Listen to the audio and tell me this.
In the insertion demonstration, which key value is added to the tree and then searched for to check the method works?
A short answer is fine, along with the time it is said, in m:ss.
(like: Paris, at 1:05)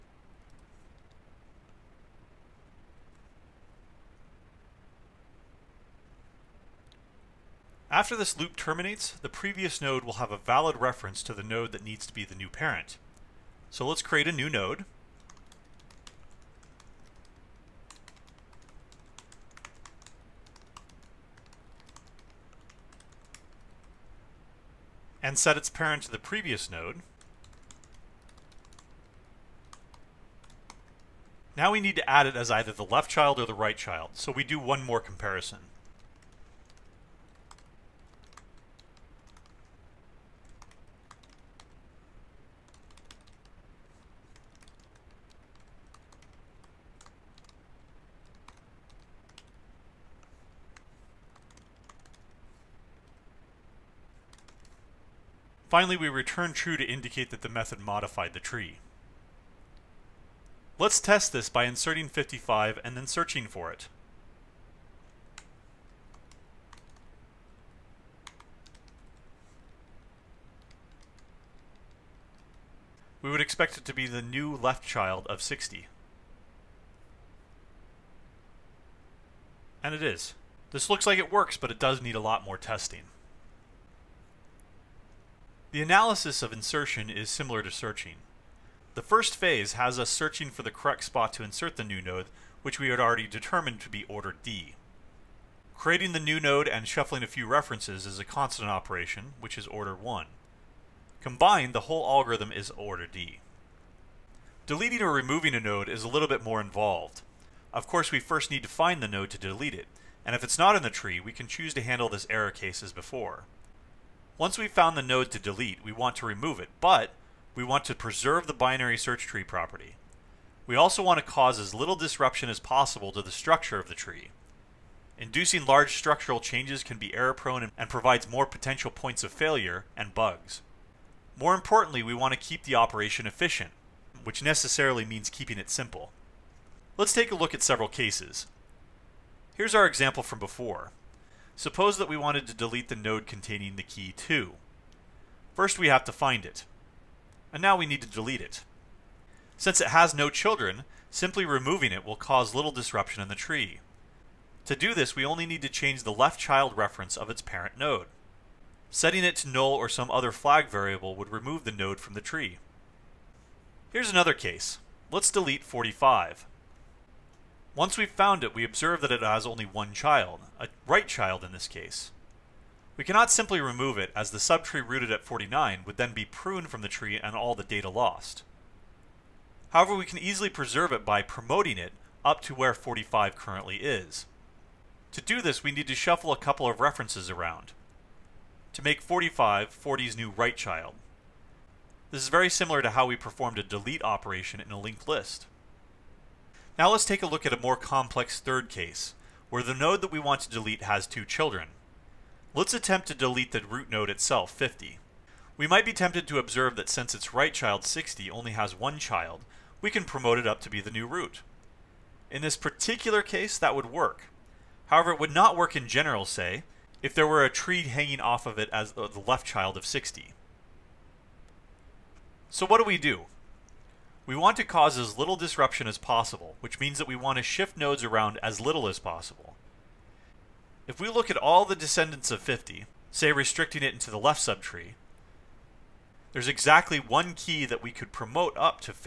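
55, at 1:02.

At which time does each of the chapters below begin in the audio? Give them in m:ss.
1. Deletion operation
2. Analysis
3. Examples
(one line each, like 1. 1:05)
1. 1:44
2. 1:25
3. 2:16.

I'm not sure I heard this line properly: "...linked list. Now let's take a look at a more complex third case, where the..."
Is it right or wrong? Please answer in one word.
right.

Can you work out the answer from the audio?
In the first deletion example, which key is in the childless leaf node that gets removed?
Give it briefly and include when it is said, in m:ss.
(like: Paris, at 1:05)
2, at 2:24.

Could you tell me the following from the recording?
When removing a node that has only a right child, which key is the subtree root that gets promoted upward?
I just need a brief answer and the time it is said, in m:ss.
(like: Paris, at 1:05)
49, at 2:55.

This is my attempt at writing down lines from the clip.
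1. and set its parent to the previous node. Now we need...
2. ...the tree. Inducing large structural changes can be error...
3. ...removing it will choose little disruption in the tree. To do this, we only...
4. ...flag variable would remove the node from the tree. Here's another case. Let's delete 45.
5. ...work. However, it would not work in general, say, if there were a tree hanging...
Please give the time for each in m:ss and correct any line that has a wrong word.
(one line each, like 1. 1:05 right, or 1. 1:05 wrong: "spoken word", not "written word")
1. 0:25 right
2. 2:03 right
3. 2:31 wrong: "cause", not "choose"
4. 2:40 right
5. 3:33 right.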